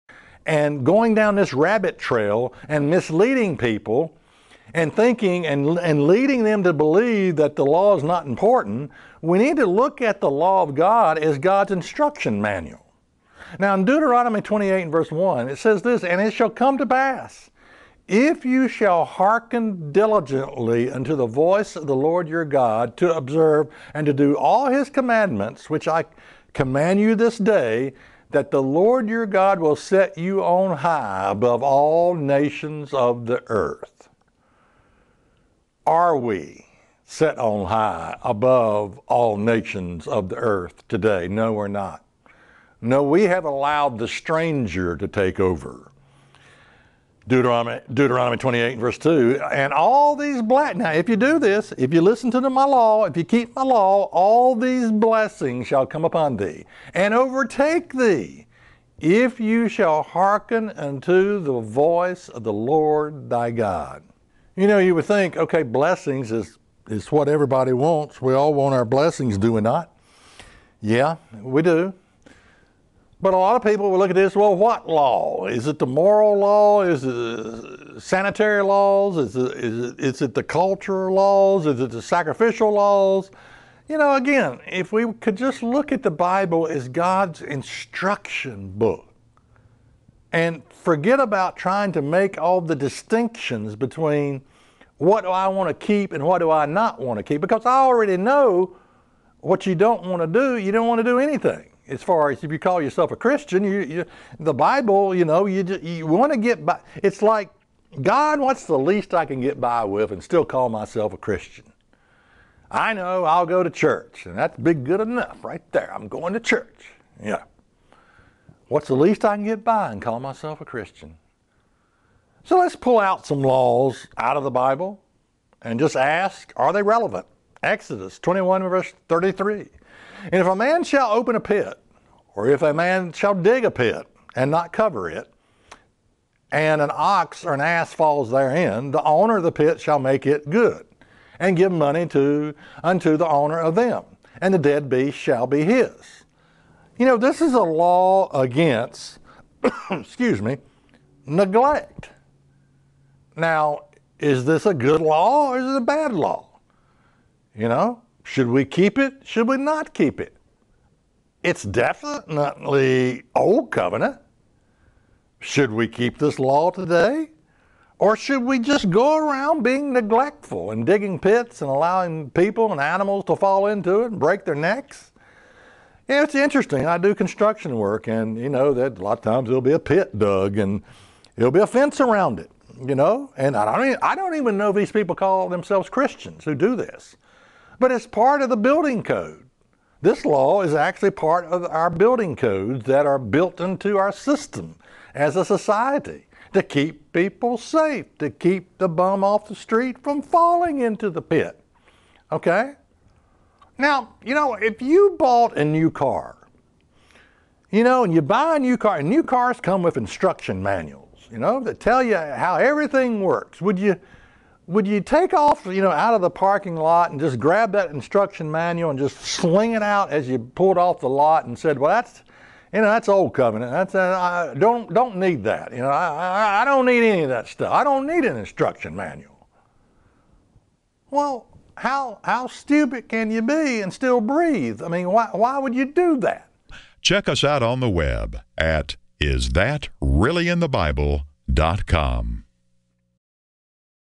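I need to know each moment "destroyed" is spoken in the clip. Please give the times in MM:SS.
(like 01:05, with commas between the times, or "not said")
not said.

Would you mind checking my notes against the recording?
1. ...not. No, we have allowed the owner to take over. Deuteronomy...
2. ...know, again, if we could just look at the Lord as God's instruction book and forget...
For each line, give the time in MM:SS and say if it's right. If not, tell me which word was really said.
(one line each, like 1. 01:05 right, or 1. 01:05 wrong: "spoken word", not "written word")
1. 00:41 wrong: "stranger", not "owner"
2. 01:23 wrong: "Bible", not "Lord".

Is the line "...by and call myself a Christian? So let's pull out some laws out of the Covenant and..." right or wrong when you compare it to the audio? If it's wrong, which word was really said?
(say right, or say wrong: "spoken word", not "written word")
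wrong: "Bible", not "Covenant".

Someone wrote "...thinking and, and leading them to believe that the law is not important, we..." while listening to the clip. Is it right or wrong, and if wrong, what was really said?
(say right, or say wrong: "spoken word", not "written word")
right.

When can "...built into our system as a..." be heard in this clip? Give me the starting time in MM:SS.
03:13.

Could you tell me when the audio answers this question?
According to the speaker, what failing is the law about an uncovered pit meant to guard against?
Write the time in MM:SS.
02:31.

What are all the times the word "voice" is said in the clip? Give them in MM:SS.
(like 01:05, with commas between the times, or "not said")
00:21, 01:01.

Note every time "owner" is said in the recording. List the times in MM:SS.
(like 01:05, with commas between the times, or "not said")
02:19, 02:23.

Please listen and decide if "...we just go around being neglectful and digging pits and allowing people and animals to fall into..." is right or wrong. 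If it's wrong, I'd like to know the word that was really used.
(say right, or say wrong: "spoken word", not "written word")
right.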